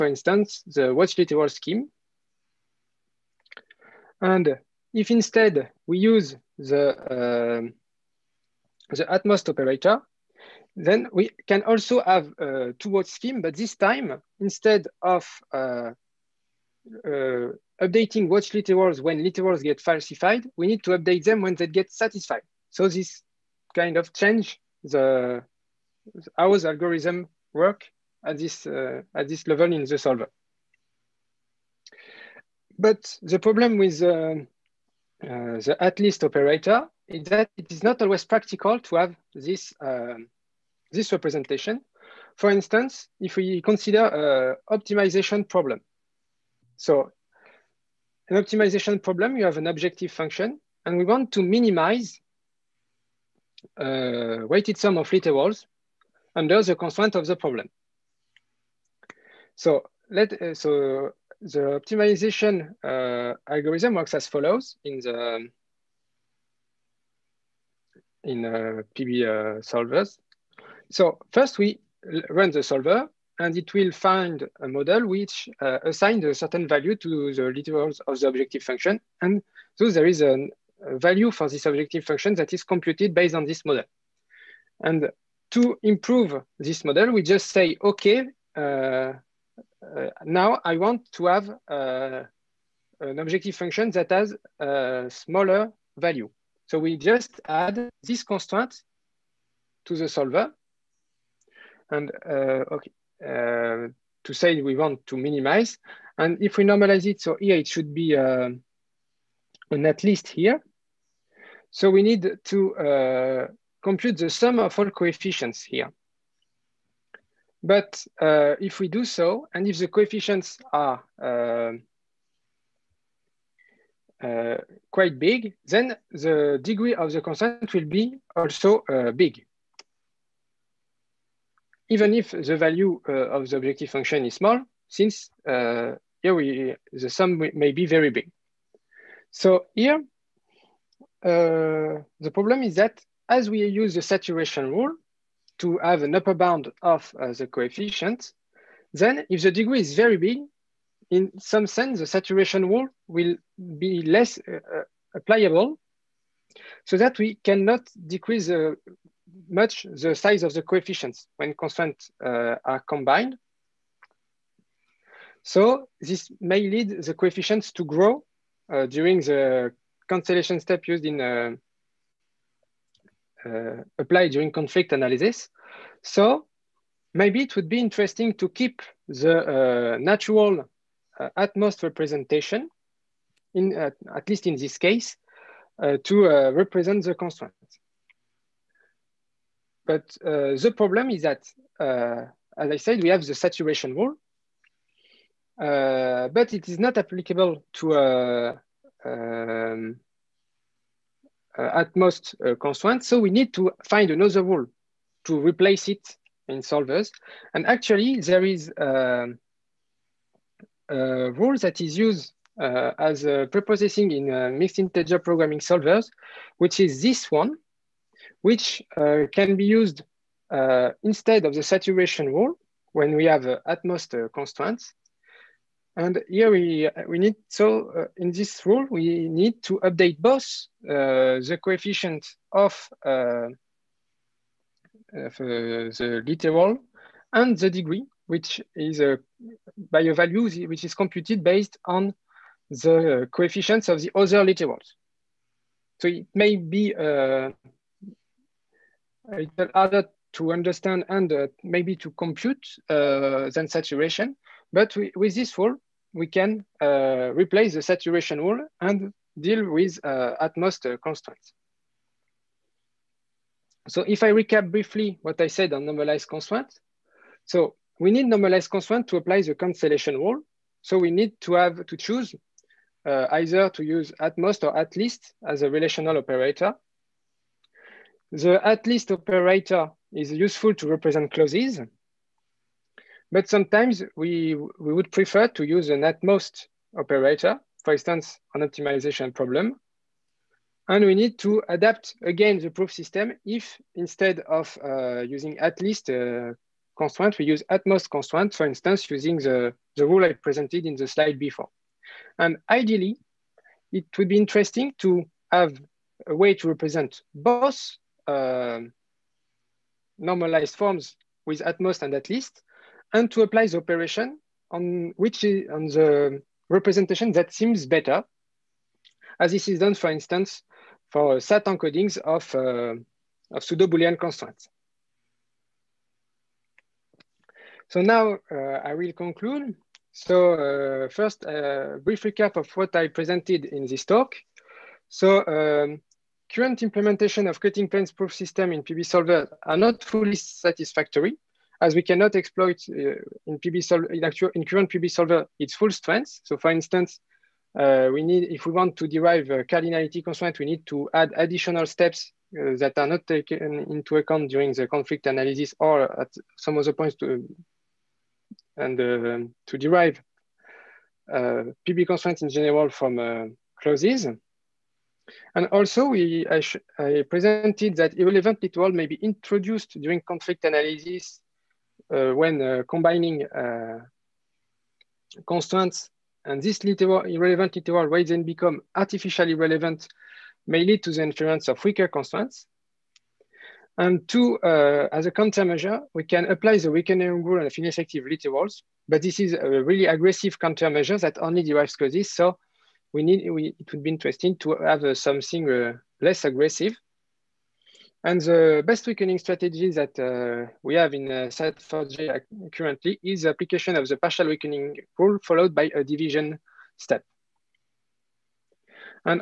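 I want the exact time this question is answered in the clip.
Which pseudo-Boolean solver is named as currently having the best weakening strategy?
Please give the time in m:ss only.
6:41.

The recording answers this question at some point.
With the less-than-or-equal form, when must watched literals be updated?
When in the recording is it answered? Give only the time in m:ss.
0:21.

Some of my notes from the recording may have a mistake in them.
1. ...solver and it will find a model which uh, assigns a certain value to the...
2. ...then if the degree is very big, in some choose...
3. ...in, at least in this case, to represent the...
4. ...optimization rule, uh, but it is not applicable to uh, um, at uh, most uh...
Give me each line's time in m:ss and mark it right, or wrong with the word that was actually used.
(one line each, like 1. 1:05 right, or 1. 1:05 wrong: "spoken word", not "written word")
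1. 1:12 right
2. 2:28 wrong: "sense", not "choose"
3. 3:03 right
4. 3:13 wrong: "saturation", not "optimization".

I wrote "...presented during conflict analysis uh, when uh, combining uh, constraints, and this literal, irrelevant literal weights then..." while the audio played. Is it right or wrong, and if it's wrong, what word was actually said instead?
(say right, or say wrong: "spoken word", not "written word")
wrong: "introduced", not "presented".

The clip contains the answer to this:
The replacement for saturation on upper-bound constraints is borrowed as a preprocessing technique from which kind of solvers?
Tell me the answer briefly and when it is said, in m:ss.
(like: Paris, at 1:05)
mixed integer programming solvers, at 3:34.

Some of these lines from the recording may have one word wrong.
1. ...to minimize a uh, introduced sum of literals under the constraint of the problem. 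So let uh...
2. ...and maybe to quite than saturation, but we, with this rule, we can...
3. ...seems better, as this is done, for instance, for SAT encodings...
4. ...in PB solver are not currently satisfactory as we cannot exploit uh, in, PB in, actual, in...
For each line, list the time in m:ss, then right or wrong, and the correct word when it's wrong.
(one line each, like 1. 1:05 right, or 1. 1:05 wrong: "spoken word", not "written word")
1. 0:51 wrong: "weighted", not "introduced"
2. 4:11 wrong: "compute", not "quite"
3. 5:17 right
4. 5:38 wrong: "fully", not "currently".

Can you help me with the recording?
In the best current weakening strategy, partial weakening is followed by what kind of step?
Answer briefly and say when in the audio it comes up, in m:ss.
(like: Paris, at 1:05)
a division step, at 6:45.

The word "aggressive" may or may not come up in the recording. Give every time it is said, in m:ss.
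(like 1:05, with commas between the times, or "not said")
6:30, 6:36.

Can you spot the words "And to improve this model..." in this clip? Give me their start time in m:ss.
1:24.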